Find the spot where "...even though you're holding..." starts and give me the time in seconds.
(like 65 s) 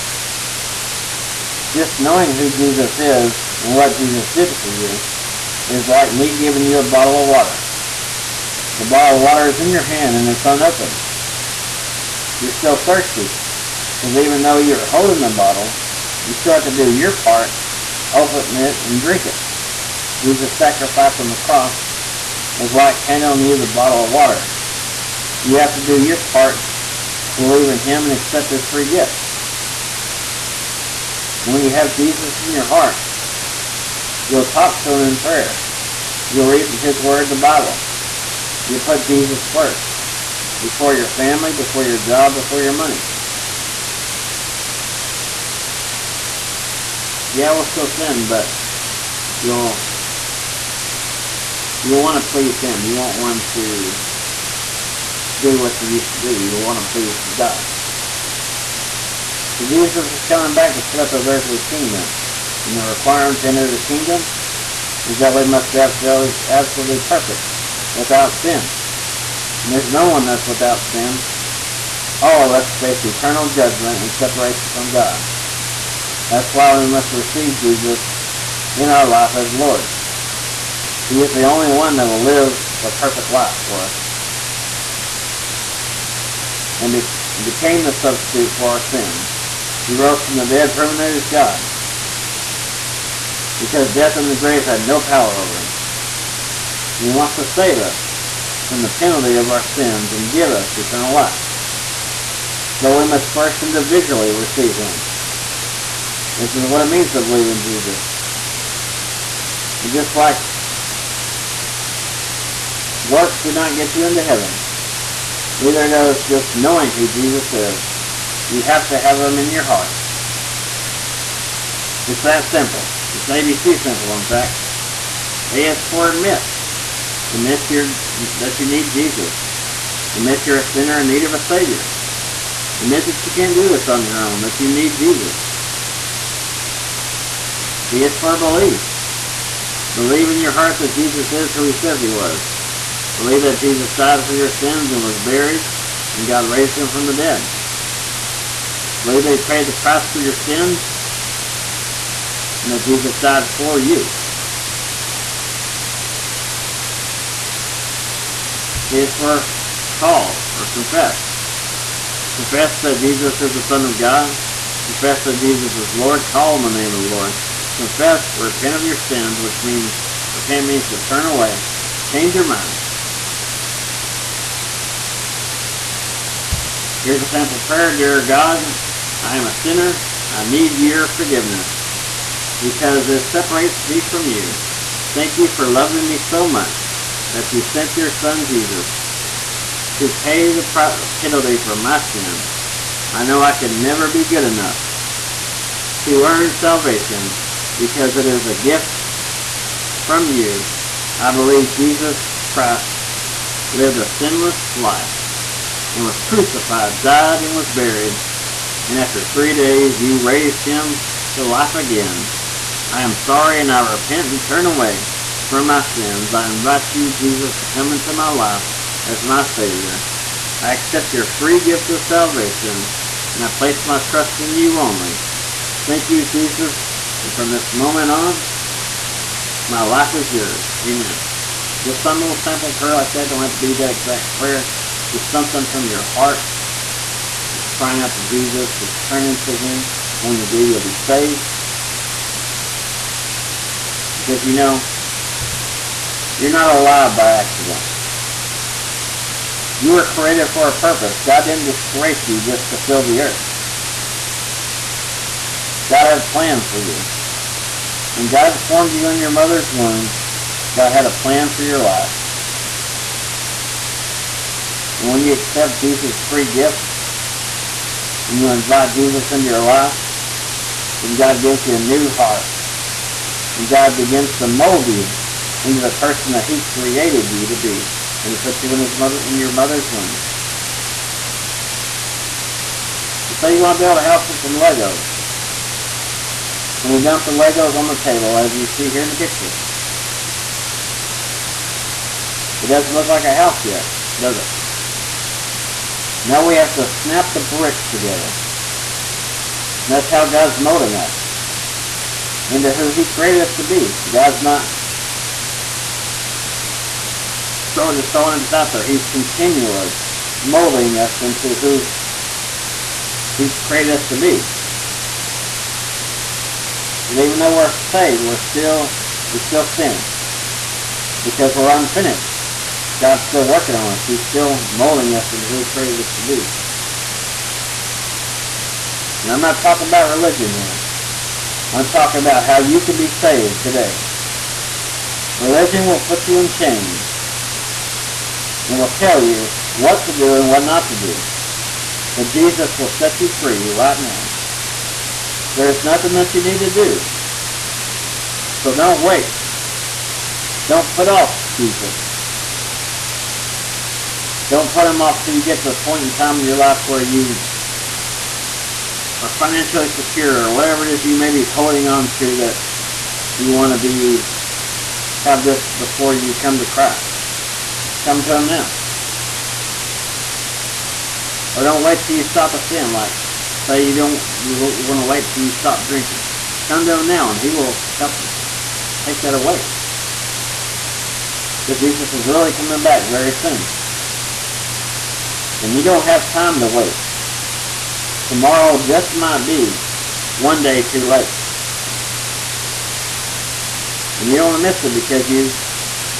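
14 s.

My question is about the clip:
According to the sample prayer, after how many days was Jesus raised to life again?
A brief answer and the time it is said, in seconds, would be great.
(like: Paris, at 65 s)
3, at 209 s.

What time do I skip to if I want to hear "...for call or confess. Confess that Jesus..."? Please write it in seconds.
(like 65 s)
159 s.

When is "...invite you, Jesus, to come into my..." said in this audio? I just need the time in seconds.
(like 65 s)
216 s.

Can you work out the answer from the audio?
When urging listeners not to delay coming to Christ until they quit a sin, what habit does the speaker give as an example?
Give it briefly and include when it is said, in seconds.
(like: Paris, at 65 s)
drinking, at 375 s.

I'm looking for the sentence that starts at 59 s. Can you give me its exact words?
So Jesus is coming back to set up his earthly kingdom.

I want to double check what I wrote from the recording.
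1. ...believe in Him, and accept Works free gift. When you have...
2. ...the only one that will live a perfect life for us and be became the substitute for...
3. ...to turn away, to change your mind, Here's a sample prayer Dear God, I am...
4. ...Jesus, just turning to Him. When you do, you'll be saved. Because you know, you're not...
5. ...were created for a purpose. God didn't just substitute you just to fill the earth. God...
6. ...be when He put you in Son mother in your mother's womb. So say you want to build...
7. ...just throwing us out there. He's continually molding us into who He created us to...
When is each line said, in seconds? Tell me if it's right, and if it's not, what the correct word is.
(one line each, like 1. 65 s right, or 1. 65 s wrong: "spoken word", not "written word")
1. 27 s wrong: "His", not "Works"
2. 81 s right
3. 170 s right
4. 238 s right
5. 249 s wrong: "create", not "substitute"
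6. 277 s wrong: "His", not "Son"
7. 308 s right.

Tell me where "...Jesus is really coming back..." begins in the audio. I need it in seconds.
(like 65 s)
381 s.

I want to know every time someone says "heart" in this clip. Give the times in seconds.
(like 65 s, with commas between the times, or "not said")
32 s, 119 s, 140 s, 236 s, 272 s.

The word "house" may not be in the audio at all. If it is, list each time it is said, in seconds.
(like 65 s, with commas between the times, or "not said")
284 s, 293 s.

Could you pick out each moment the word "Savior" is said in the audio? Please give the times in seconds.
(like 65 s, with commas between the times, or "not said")
131 s, 219 s.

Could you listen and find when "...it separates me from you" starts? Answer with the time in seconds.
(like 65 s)
183 s.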